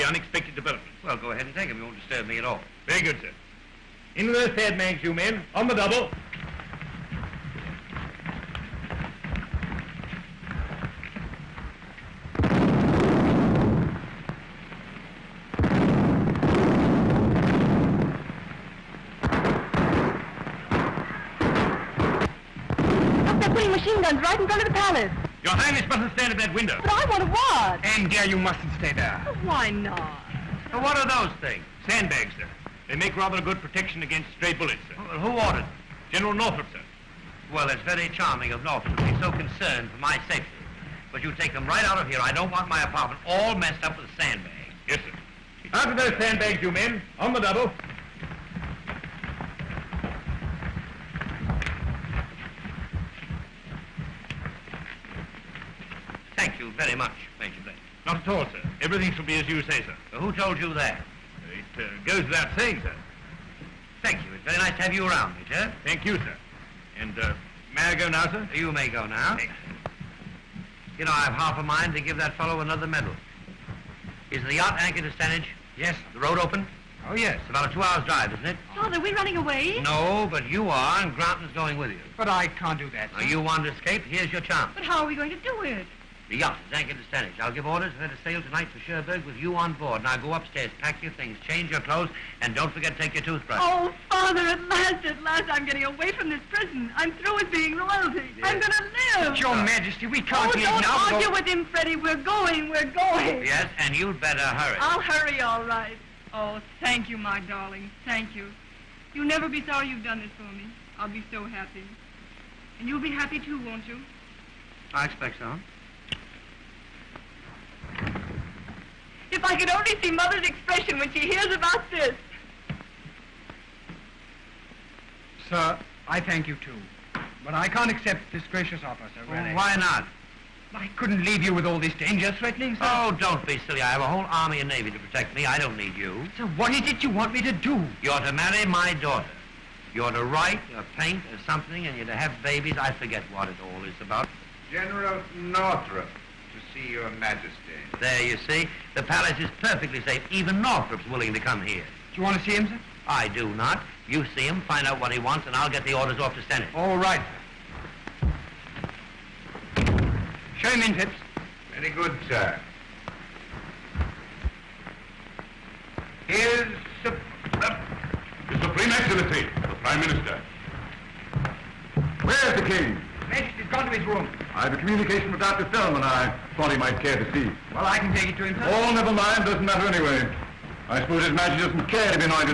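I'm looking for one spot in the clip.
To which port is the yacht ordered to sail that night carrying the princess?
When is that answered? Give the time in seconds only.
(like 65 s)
88 s.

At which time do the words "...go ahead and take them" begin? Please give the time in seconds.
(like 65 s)
1 s.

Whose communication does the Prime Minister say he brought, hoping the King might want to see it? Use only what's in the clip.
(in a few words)
Dr. Fellman.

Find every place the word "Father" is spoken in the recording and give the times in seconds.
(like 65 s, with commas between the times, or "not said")
78 s, 94 s.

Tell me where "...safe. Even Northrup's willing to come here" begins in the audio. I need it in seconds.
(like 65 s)
150 s.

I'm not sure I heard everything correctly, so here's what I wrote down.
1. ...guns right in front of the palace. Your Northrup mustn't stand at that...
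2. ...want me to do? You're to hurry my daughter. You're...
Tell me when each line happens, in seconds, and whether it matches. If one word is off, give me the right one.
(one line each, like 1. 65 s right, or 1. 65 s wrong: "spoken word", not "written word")
1. 24 s wrong: "Highness", not "Northrup"
2. 137 s wrong: "marry", not "hurry".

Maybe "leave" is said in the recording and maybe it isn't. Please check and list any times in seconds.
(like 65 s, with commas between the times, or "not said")
100 s, 131 s.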